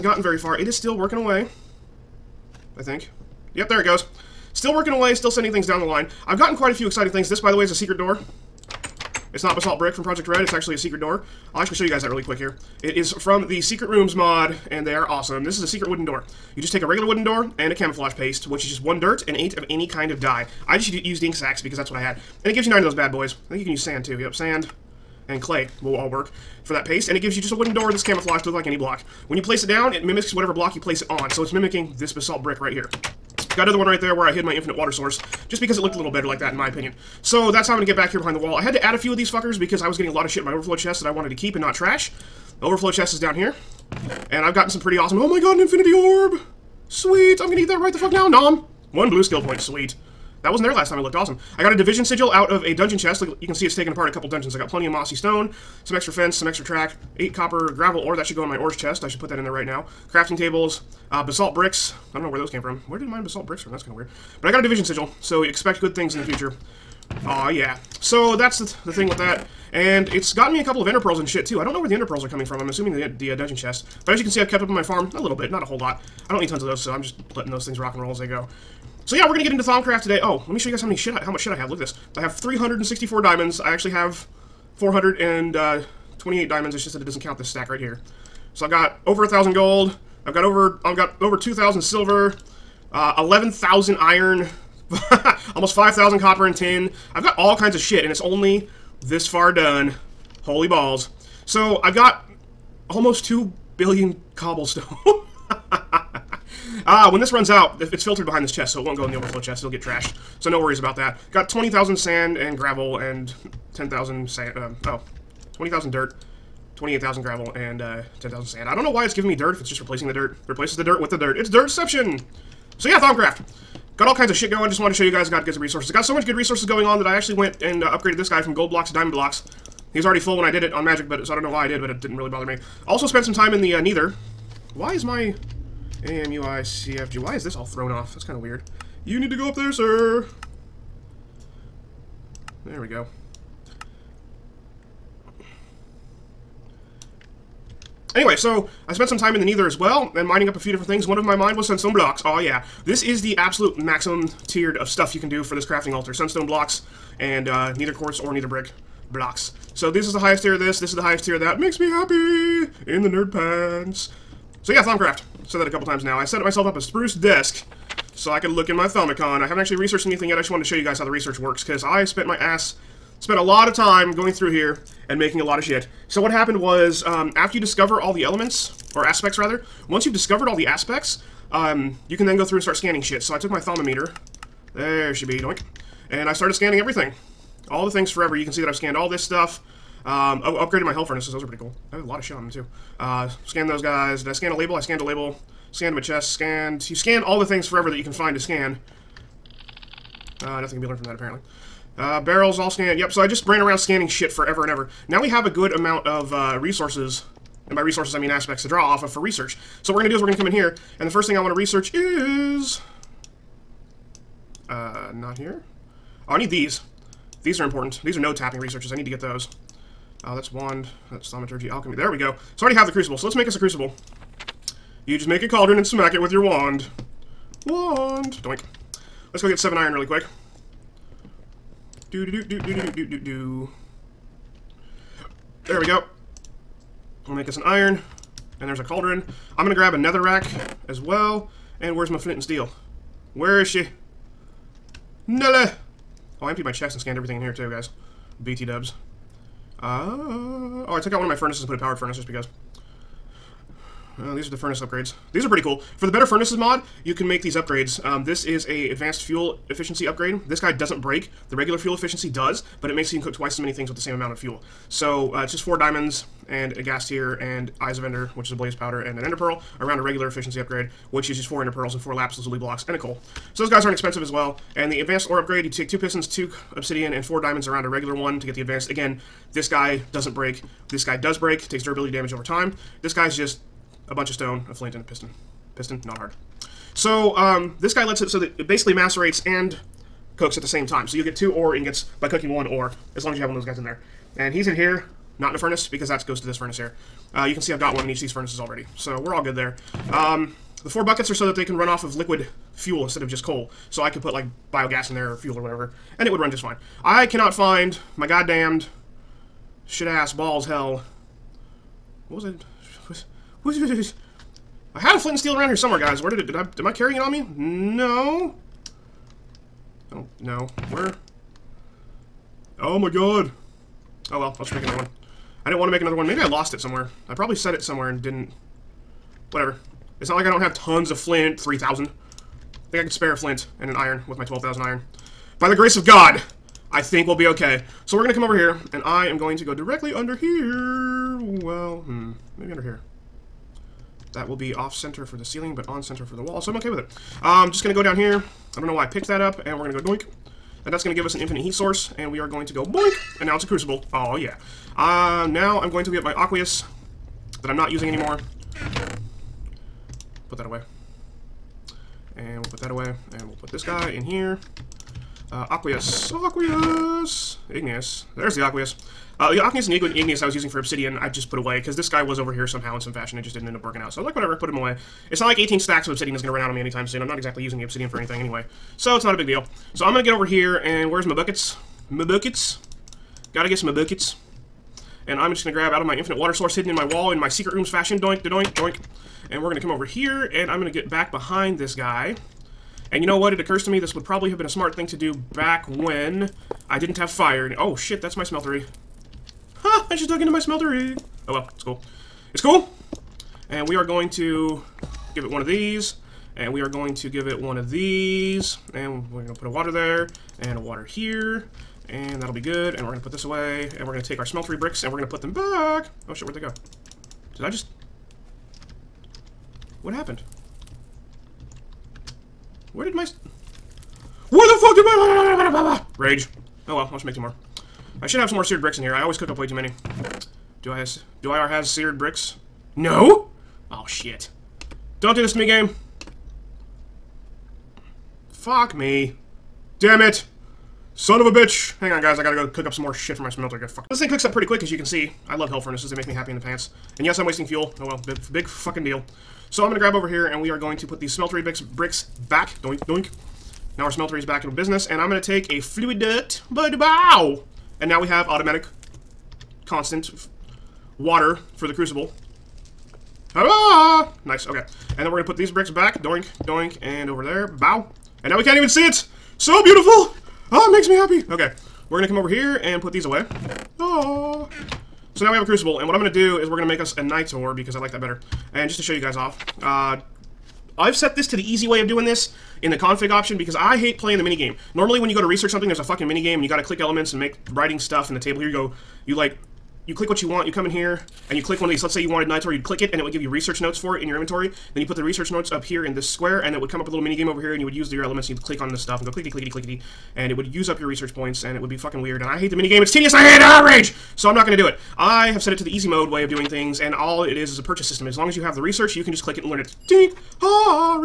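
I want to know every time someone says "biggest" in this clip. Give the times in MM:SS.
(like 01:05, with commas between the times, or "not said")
not said.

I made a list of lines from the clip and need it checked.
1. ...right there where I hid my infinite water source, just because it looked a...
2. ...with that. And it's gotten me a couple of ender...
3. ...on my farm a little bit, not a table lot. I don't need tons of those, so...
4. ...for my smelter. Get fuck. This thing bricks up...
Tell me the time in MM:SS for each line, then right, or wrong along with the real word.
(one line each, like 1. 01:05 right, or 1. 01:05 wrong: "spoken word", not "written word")
1. 00:33 right
2. 01:09 right
3. 01:14 wrong: "whole", not "table"
4. 07:23 wrong: "cooks", not "bricks".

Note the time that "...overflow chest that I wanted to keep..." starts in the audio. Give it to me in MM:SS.
00:40.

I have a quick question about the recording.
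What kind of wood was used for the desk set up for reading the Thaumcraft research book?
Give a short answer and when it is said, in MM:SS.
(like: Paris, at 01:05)
spruce, at 02:46.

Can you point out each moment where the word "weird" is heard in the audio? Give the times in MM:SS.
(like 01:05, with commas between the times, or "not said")
01:03, 02:18, 08:22.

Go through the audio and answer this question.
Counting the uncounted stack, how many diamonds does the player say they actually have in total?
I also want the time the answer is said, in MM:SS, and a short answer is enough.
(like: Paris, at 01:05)
428, at 01:24.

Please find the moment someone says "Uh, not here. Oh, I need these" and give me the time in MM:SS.
03:34.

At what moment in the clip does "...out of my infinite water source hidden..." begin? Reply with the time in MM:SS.
06:25.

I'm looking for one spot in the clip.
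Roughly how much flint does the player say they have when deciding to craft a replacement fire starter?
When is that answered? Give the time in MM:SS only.
05:31.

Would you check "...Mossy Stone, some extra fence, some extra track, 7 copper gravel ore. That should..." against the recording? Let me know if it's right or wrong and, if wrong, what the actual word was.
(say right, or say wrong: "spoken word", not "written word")
wrong: "8", not "7".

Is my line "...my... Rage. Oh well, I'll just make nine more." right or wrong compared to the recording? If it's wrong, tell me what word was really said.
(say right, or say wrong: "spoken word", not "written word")
wrong: "two", not "nine".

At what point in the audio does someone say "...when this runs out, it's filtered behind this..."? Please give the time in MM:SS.
01:47.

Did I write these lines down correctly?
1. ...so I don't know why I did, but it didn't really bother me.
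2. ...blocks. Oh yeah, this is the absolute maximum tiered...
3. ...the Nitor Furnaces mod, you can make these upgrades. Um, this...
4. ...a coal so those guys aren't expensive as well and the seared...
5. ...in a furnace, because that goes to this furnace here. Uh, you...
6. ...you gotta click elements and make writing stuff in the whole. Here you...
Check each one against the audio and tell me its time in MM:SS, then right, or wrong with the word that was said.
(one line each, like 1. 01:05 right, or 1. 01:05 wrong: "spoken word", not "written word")
1. 02:11 right
2. 02:31 right
3. 04:16 wrong: "Better", not "Nitor"
4. 04:32 wrong: "advanced", not "seared"
5. 04:55 right
6. 08:06 wrong: "table", not "whole".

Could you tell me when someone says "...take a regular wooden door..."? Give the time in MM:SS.
00:16.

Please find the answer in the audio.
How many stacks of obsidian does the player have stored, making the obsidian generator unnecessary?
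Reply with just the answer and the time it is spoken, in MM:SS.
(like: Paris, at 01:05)
18, at 06:15.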